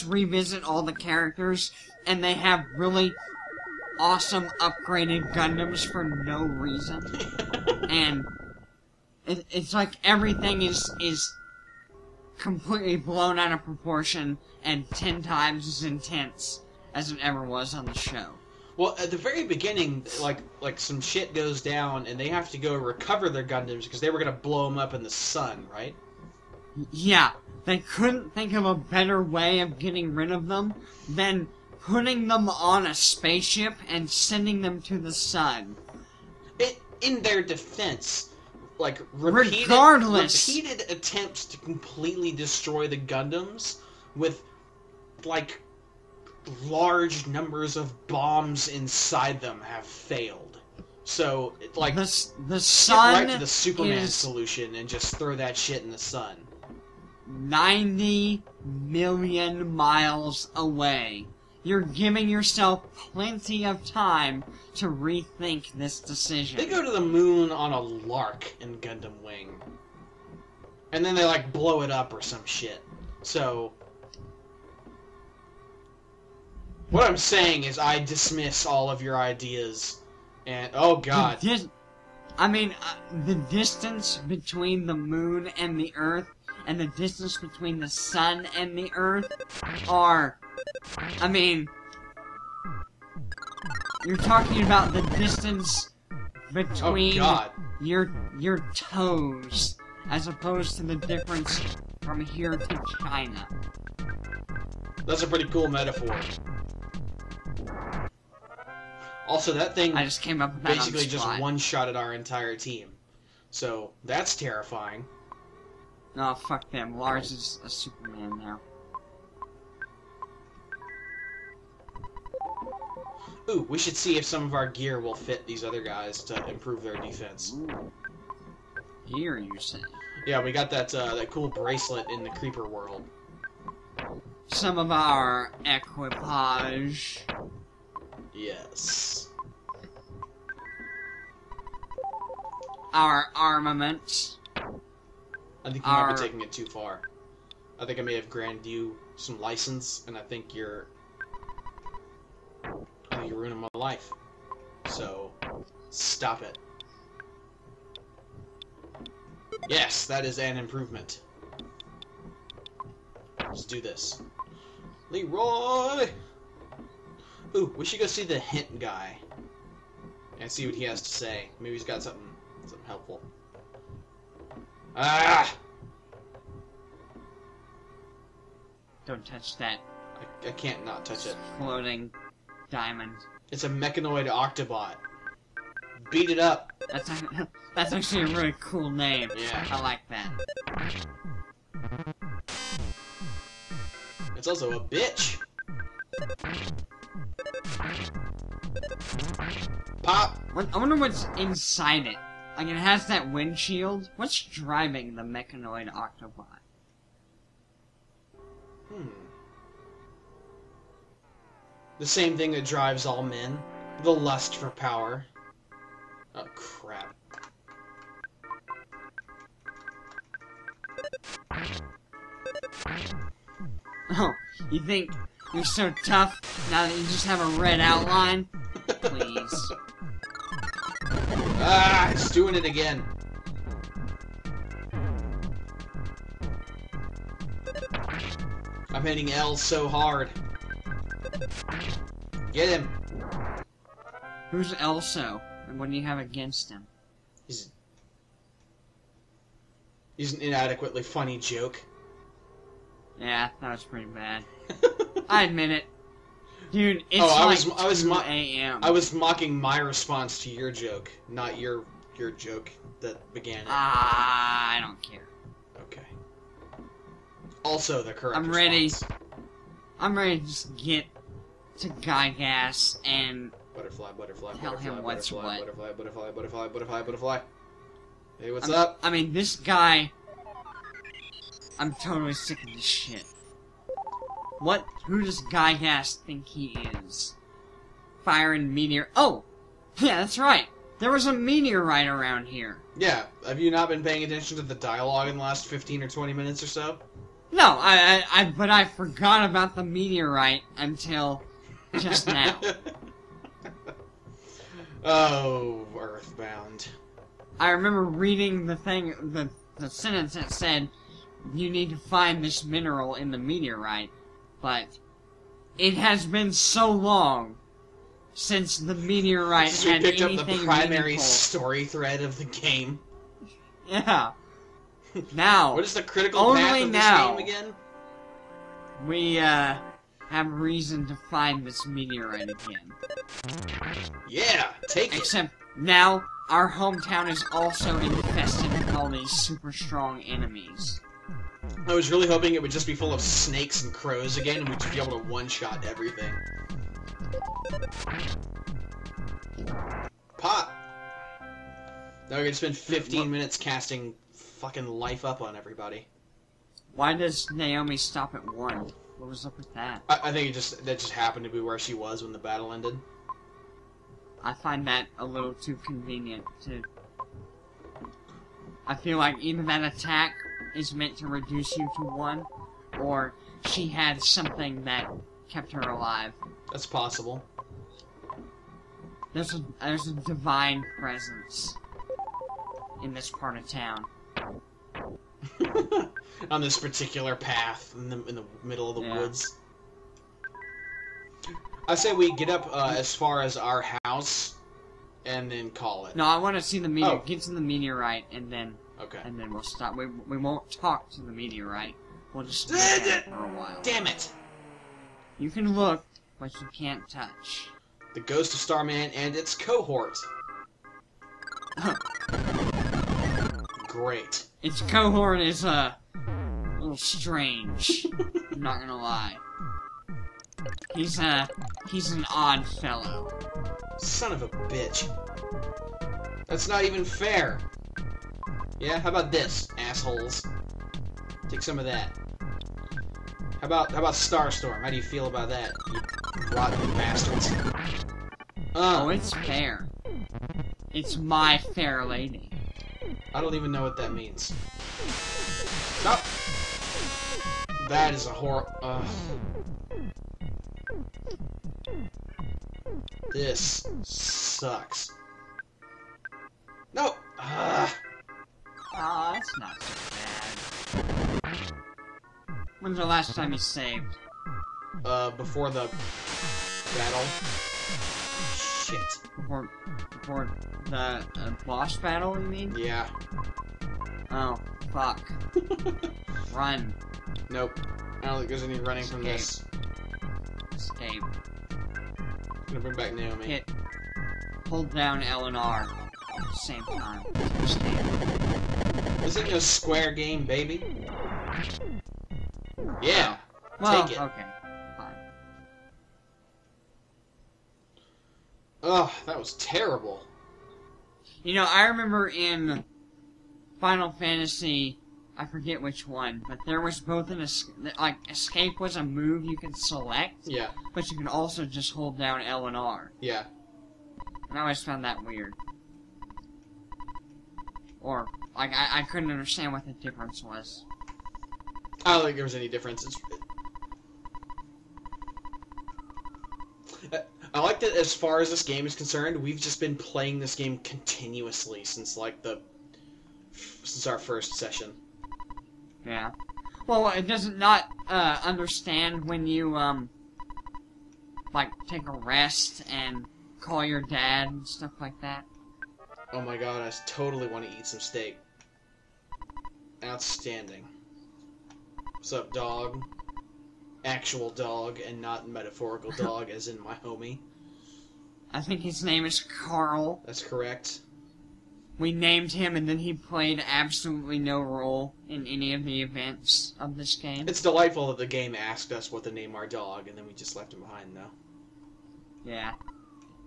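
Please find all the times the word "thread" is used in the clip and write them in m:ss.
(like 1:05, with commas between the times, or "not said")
5:21.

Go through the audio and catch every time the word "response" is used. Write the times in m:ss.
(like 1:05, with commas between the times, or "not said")
4:19, 4:28.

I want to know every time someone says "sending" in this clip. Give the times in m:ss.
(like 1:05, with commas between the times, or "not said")
0:34.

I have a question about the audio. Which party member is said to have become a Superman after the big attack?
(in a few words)
Lars.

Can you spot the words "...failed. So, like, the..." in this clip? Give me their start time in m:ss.
0:49.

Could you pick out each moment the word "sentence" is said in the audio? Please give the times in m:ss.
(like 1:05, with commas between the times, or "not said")
5:09.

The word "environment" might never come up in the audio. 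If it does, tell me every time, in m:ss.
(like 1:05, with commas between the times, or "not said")
not said.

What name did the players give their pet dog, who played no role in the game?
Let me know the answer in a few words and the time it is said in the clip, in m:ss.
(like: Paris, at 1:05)
Carl, at 9:19.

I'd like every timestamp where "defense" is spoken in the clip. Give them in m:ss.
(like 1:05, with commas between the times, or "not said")
0:37, 2:06.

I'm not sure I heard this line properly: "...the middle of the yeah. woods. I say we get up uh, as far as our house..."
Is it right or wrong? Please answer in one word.
right.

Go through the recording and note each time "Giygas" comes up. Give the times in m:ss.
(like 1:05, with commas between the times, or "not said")
4:31, 4:45.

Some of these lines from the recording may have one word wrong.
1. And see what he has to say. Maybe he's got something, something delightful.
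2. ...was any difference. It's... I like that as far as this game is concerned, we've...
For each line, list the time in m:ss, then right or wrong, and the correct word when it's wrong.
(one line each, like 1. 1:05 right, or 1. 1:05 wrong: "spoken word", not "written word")
1. 2:50 wrong: "helpful", not "delightful"
2. 8:42 right.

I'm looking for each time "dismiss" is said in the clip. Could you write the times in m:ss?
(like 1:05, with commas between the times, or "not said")
1:17.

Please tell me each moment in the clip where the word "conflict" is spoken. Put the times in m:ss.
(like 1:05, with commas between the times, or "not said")
not said.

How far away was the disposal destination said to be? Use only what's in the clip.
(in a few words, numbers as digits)
90 million miles.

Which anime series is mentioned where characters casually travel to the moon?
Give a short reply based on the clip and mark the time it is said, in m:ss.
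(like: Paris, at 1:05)
Gundam Wing, at 1:08.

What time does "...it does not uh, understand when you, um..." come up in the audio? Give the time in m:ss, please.
8:57.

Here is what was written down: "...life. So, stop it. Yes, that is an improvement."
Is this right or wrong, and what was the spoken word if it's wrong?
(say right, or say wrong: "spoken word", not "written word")
right.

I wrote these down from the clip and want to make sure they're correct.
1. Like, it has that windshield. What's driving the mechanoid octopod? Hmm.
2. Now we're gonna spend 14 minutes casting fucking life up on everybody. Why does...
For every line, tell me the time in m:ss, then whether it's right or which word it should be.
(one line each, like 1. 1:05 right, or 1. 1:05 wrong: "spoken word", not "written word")
1. 3:22 right
2. 5:52 wrong: "15", not "14".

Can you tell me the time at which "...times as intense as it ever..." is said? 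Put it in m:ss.
0:15.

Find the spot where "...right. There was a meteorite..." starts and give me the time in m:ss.
4:50.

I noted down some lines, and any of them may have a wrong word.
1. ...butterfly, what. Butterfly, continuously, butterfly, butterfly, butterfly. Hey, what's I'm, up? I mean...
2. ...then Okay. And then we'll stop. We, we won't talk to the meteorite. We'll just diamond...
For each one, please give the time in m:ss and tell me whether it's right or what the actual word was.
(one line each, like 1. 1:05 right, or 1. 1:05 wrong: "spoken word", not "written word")
1. 4:35 wrong: "butterfly", not "continuously"
2. 6:38 wrong: "stand", not "diamond".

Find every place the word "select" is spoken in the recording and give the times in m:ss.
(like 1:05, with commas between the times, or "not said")
8:29.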